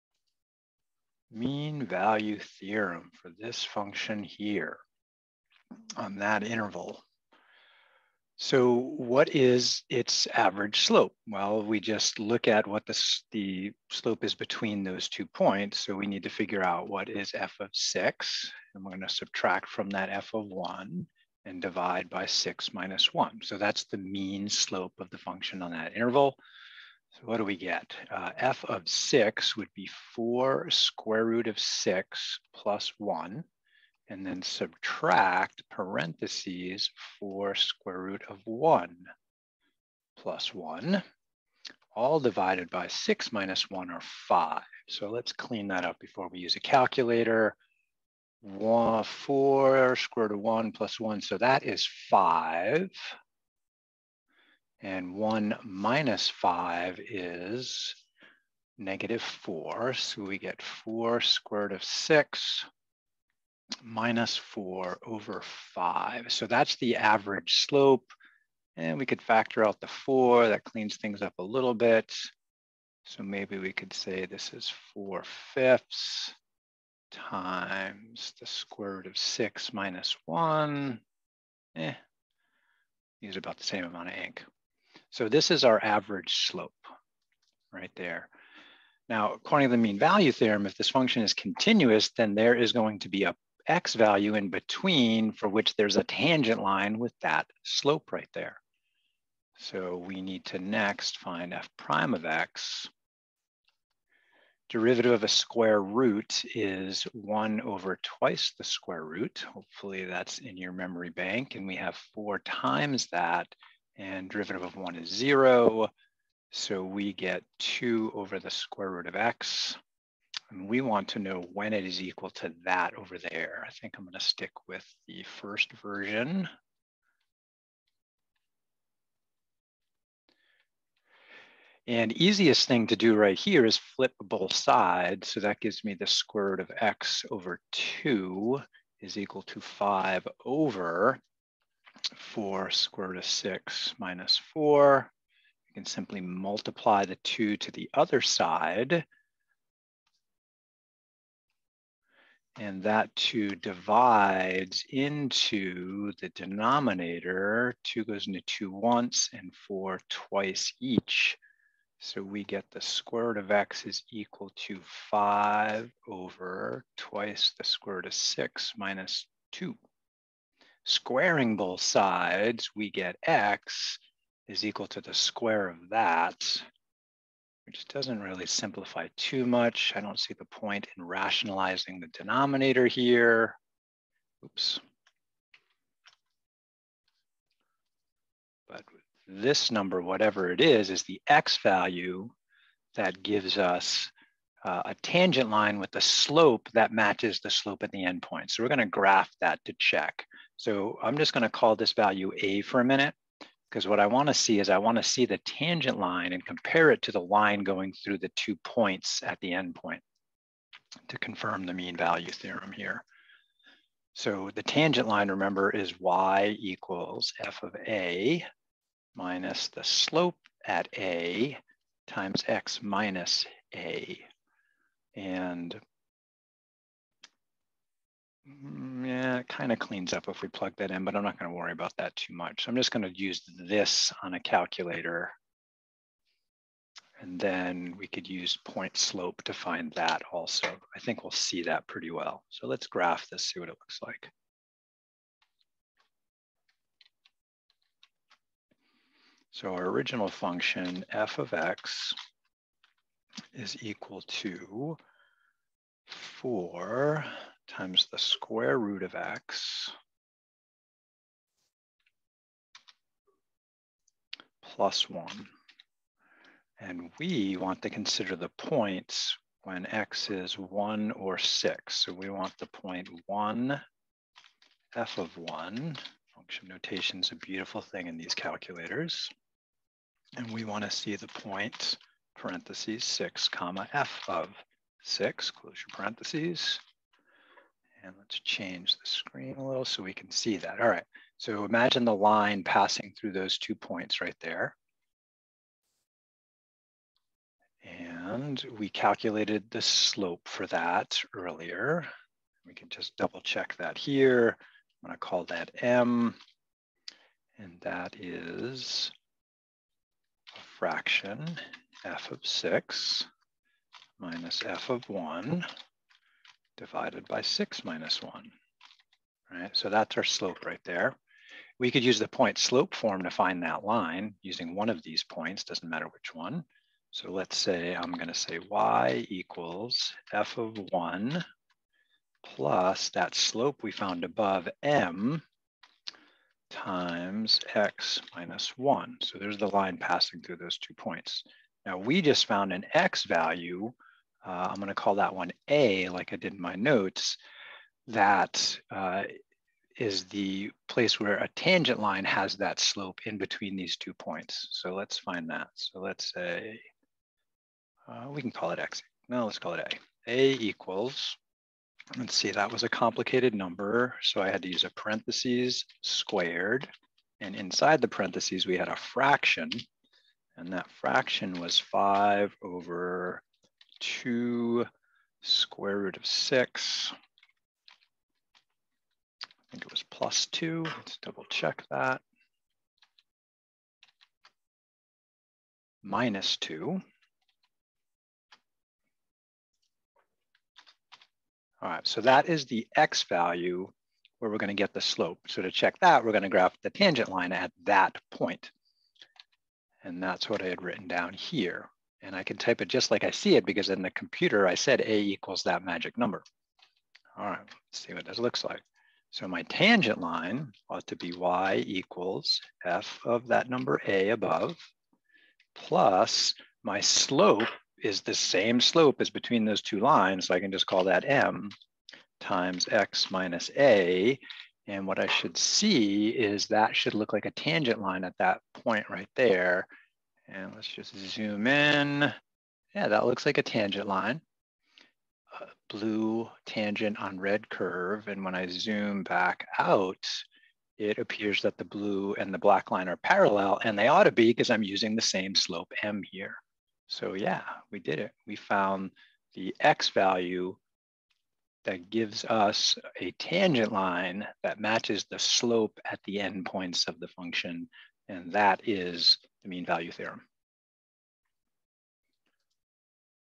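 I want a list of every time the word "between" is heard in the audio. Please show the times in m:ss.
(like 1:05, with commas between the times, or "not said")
0:14, 1:34, 5:53, 6:59.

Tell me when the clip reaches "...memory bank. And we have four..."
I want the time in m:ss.
1:50.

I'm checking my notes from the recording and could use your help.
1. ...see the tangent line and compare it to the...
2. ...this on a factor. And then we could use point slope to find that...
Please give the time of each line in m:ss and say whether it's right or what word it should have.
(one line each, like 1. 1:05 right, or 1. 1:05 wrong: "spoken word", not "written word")
1. 3:25 right
2. 3:53 wrong: "calculator", not "factor".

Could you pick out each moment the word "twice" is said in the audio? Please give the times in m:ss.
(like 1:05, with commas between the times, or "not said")
1:48, 2:40, 2:46.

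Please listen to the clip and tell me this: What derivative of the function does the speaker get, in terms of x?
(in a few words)
2 over the square root of x.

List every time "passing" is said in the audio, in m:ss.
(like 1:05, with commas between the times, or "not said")
4:52, 5:39.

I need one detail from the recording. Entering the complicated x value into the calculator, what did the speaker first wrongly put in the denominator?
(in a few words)
plus 2.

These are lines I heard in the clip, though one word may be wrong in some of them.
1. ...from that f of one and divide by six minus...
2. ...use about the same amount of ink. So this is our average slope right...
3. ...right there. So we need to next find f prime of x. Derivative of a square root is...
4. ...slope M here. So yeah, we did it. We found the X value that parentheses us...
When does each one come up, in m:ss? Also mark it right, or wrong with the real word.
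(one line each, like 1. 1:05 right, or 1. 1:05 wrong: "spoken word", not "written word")
1. 0:19 right
2. 1:23 right
3. 1:38 right
4. 7:25 wrong: "gives", not "parentheses".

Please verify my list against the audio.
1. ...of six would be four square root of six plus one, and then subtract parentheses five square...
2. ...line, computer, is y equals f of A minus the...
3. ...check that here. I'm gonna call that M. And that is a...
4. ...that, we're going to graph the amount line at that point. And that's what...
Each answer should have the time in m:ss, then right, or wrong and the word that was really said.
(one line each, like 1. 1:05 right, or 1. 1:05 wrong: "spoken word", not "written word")
1. 0:28 wrong: "four", not "five"
2. 3:35 wrong: "remember", not "computer"
3. 5:03 right
4. 6:36 wrong: "tangent", not "amount".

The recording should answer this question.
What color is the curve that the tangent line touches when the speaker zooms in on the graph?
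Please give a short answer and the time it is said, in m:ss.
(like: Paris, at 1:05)
red, at 7:17.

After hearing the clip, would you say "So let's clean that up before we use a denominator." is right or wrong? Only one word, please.
wrong.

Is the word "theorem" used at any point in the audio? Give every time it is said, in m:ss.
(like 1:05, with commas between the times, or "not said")
0:02, 1:30, 3:32, 7:40.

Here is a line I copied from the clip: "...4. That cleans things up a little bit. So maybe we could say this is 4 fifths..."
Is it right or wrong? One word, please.
right.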